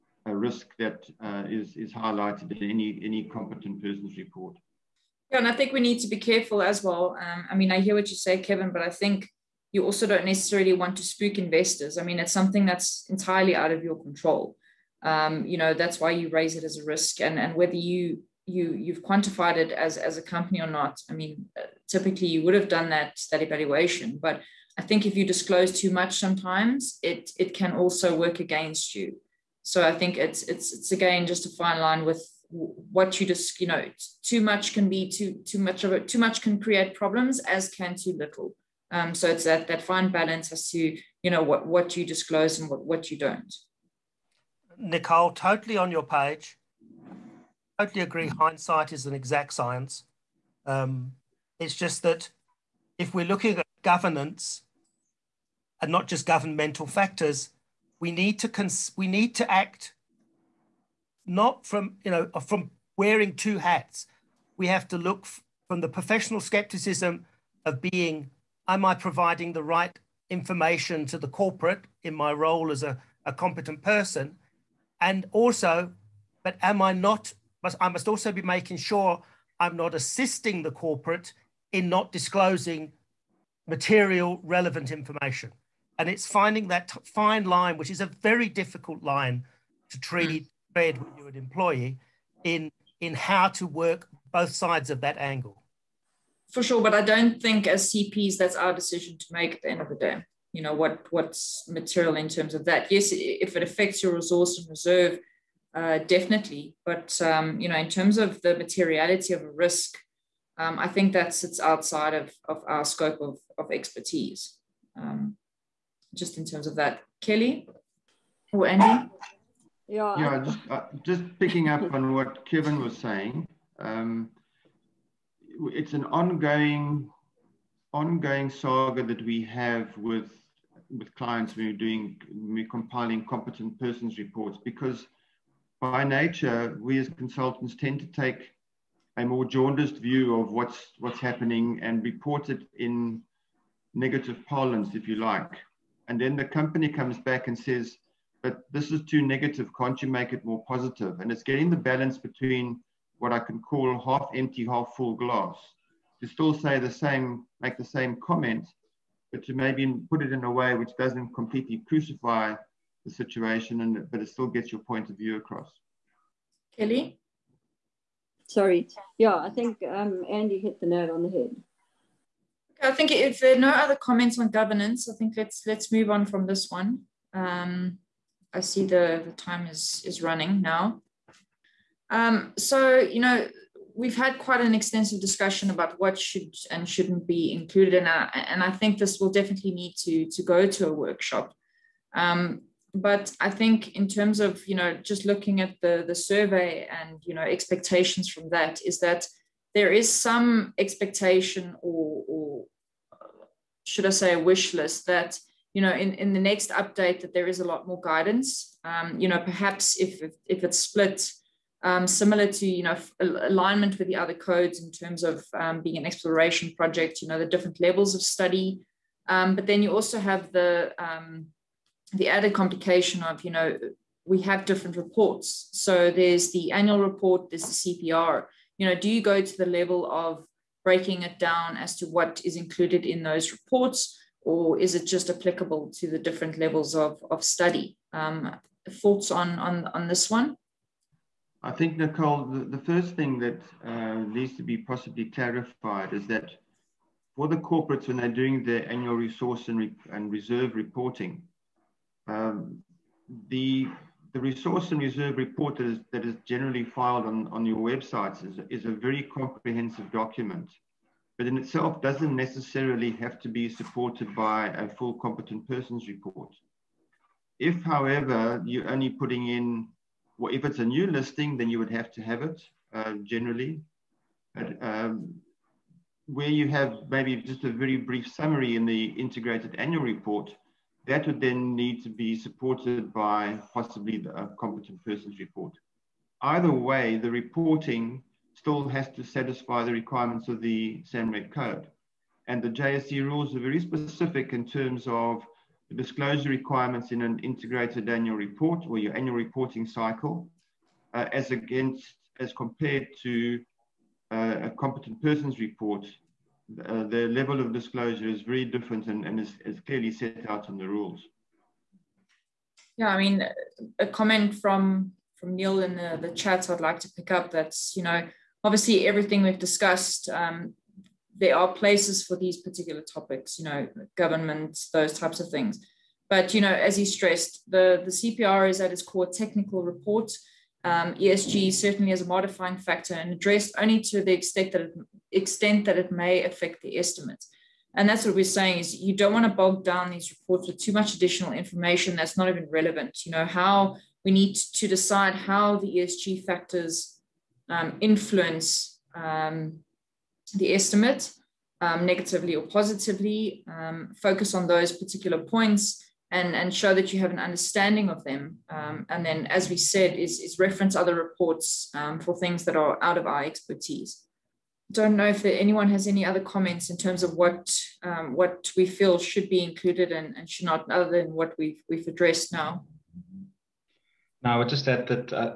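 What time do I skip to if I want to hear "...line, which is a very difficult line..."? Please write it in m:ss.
1:27.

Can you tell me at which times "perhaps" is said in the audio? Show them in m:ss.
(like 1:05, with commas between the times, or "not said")
3:29.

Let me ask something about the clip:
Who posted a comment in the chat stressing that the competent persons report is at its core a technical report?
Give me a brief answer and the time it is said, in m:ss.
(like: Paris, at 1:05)
Neil, at 5:15.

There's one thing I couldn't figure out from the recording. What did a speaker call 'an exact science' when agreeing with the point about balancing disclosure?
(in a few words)
hindsight.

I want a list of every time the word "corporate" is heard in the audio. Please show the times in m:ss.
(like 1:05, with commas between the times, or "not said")
1:11, 1:20, 4:07.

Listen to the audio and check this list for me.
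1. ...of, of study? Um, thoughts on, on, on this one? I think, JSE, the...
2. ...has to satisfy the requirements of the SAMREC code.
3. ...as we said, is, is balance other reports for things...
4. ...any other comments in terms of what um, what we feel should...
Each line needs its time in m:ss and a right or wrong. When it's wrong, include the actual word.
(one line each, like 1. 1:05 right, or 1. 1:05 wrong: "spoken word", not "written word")
1. 3:56 wrong: "Nicole", not "JSE"
2. 4:48 right
3. 5:59 wrong: "reference", not "balance"
4. 6:06 right.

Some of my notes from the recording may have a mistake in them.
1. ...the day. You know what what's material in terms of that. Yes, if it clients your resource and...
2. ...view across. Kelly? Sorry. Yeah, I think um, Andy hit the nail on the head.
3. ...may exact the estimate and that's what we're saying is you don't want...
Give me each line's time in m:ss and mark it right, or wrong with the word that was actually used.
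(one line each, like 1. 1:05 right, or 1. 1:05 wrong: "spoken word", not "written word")
1. 1:39 wrong: "affects", not "clients"
2. 2:45 right
3. 5:36 wrong: "affect", not "exact".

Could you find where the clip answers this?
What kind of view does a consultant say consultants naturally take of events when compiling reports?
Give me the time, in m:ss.
2:19.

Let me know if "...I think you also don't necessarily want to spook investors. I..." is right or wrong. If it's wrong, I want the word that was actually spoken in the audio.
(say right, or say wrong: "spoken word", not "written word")
right.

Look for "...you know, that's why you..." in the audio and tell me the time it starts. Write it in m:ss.
0:15.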